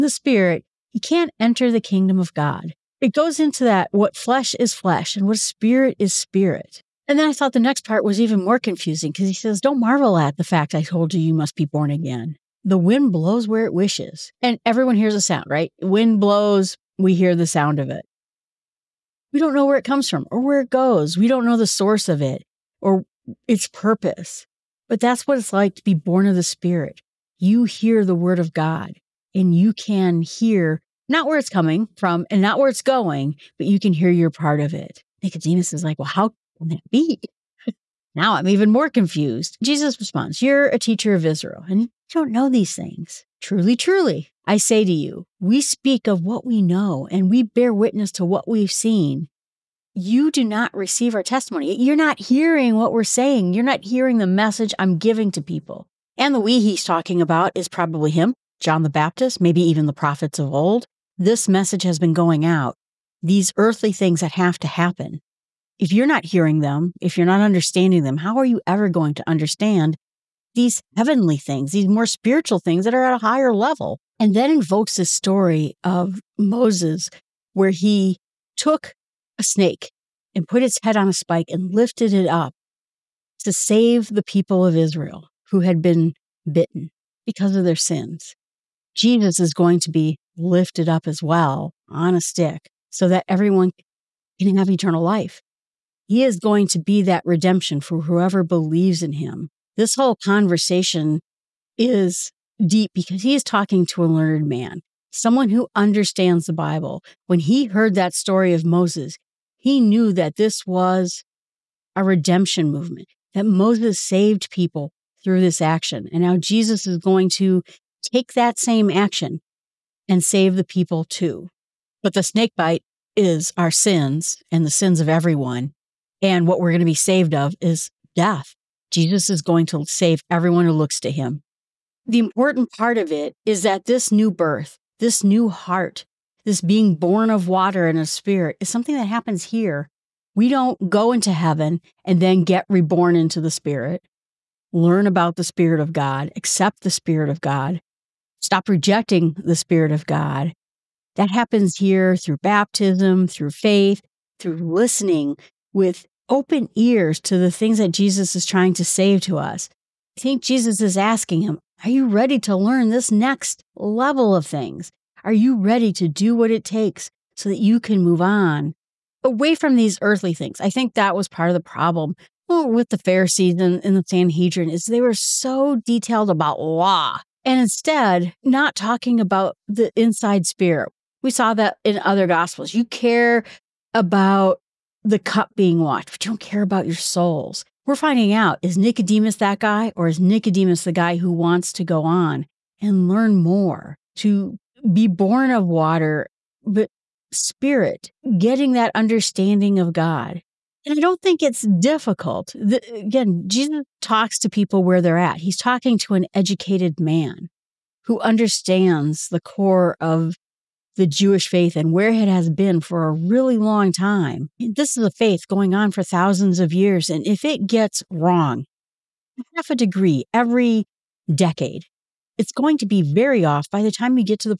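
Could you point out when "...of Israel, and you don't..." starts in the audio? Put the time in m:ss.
0:41.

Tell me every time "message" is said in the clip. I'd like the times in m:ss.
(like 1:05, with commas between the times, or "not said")
0:54, 1:01.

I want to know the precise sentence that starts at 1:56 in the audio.
And now Jesus is going to take that same action and save the people too.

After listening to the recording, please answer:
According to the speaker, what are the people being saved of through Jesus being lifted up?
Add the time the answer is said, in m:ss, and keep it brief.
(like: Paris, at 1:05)
Death, at 2:08.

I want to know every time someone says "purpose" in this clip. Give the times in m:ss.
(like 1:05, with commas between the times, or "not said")
0:23.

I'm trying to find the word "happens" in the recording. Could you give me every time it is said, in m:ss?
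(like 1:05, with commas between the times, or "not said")
1:04, 2:19, 2:31.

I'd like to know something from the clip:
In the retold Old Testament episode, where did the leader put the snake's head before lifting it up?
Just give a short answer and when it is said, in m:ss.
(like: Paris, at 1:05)
On a spike, at 1:20.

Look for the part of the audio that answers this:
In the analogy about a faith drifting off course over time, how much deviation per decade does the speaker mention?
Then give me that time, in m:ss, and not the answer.
3:39.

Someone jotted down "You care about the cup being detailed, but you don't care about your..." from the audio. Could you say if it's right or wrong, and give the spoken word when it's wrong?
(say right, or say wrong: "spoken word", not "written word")
wrong: "washed", not "detailed".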